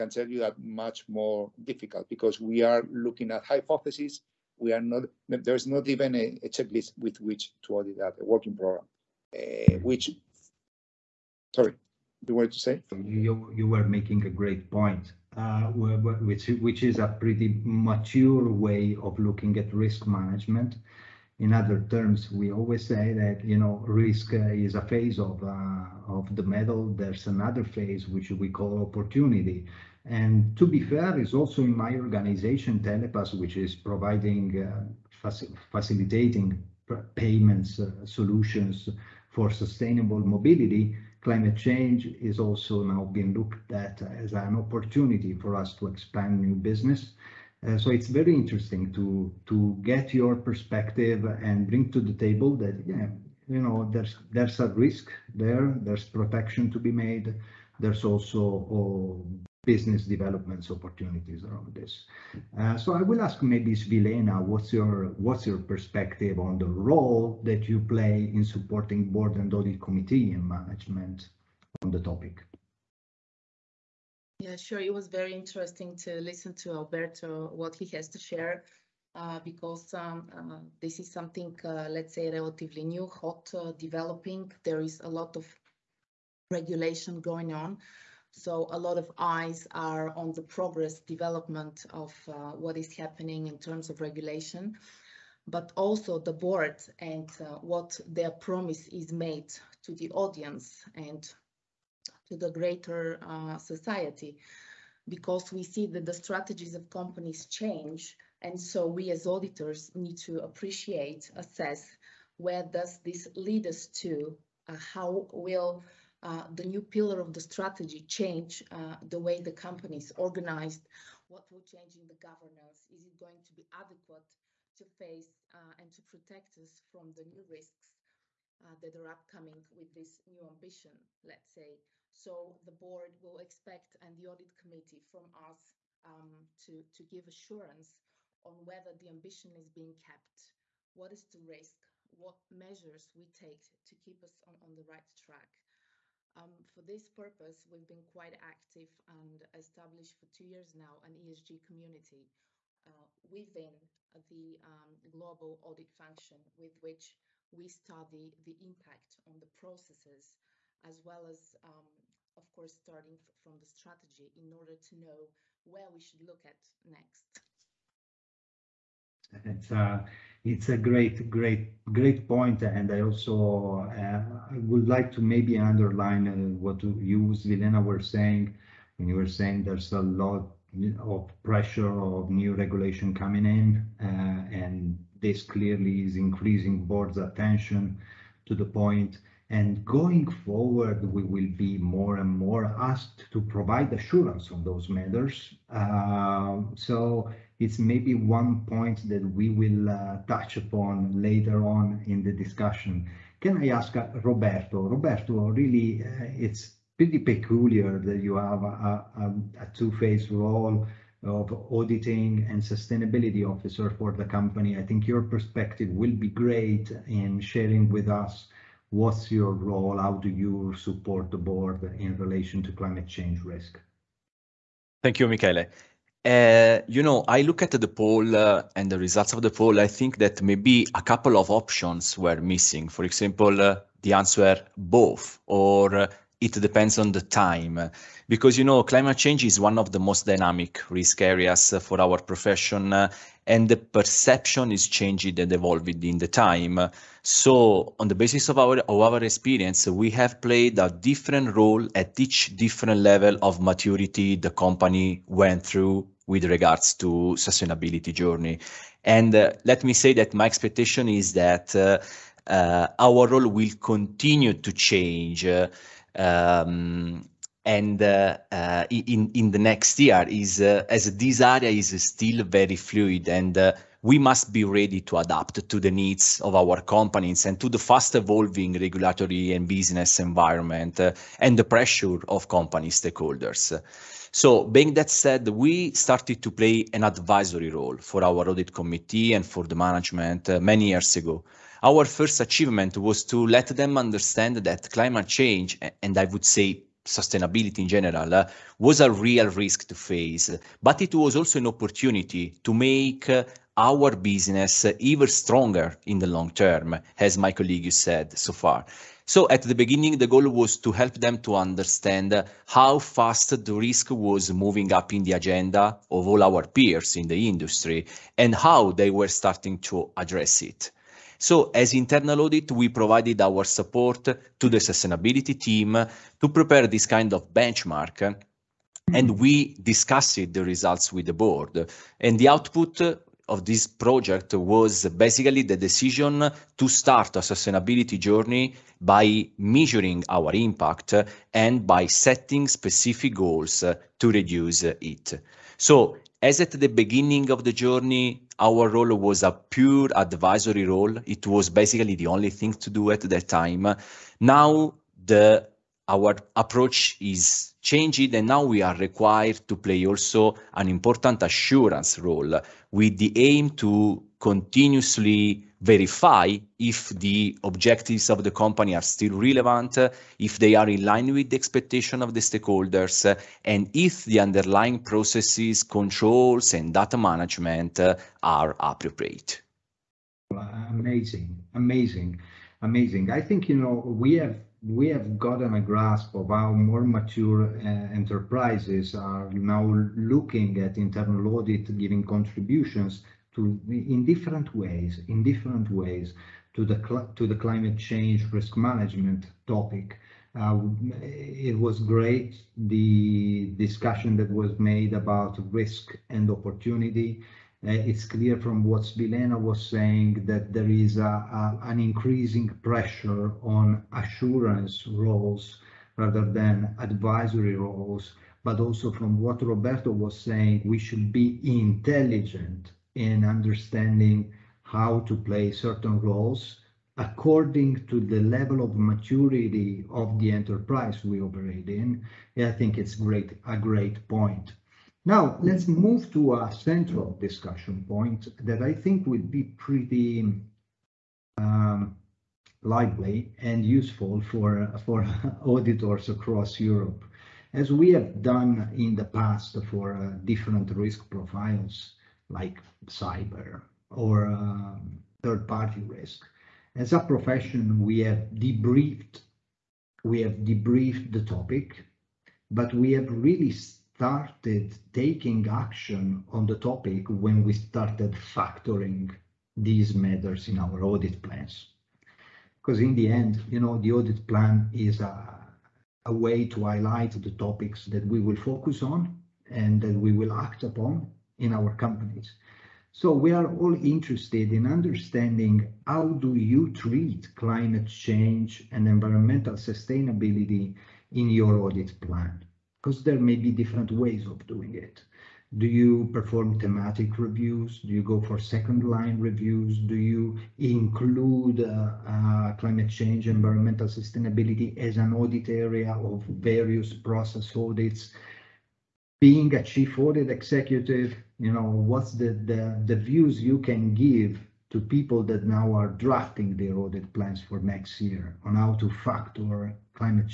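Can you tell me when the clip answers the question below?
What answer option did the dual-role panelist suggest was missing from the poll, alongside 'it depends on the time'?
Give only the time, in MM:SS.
03:54.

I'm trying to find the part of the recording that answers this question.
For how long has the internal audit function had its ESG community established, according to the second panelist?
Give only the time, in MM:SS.
02:30.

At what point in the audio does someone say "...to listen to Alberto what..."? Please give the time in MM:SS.
01:15.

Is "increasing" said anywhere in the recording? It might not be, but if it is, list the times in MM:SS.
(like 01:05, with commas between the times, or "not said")
03:06, 06:51.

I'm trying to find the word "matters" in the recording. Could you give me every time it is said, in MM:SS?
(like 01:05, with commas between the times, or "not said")
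03:14, 07:50.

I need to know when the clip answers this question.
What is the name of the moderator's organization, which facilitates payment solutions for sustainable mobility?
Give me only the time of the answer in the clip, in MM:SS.
00:32.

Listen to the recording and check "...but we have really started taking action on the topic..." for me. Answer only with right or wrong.
right.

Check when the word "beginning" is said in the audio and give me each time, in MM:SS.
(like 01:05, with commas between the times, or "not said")
05:09, 05:46.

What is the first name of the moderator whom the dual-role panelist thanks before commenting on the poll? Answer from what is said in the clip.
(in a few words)
Michele.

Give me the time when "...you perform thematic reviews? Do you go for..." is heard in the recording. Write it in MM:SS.
08:15.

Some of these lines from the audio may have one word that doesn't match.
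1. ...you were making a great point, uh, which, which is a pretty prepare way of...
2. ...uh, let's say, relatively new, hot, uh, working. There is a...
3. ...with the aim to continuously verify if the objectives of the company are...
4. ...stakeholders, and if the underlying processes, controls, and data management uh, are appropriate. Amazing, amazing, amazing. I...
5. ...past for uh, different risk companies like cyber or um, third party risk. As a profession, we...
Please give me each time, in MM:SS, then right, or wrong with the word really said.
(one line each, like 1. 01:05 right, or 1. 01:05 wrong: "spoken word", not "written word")
1. 00:13 wrong: "mature", not "prepare"
2. 01:21 wrong: "developing", not "working"
3. 06:02 right
4. 06:12 right
5. 07:29 wrong: "profiles", not "companies".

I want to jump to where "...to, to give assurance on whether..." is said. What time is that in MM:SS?
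02:16.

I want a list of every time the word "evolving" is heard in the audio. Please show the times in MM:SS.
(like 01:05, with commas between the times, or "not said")
04:05, 04:38.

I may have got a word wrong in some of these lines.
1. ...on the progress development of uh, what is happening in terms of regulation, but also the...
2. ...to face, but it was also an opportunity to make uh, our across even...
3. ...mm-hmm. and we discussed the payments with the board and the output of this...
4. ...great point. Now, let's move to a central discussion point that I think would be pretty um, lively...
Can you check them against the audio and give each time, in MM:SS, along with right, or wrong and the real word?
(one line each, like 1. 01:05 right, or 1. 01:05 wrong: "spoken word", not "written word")
1. 01:30 right
2. 04:59 wrong: "business", not "across"
3. 05:28 wrong: "results", not "payments"
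4. 07:13 right.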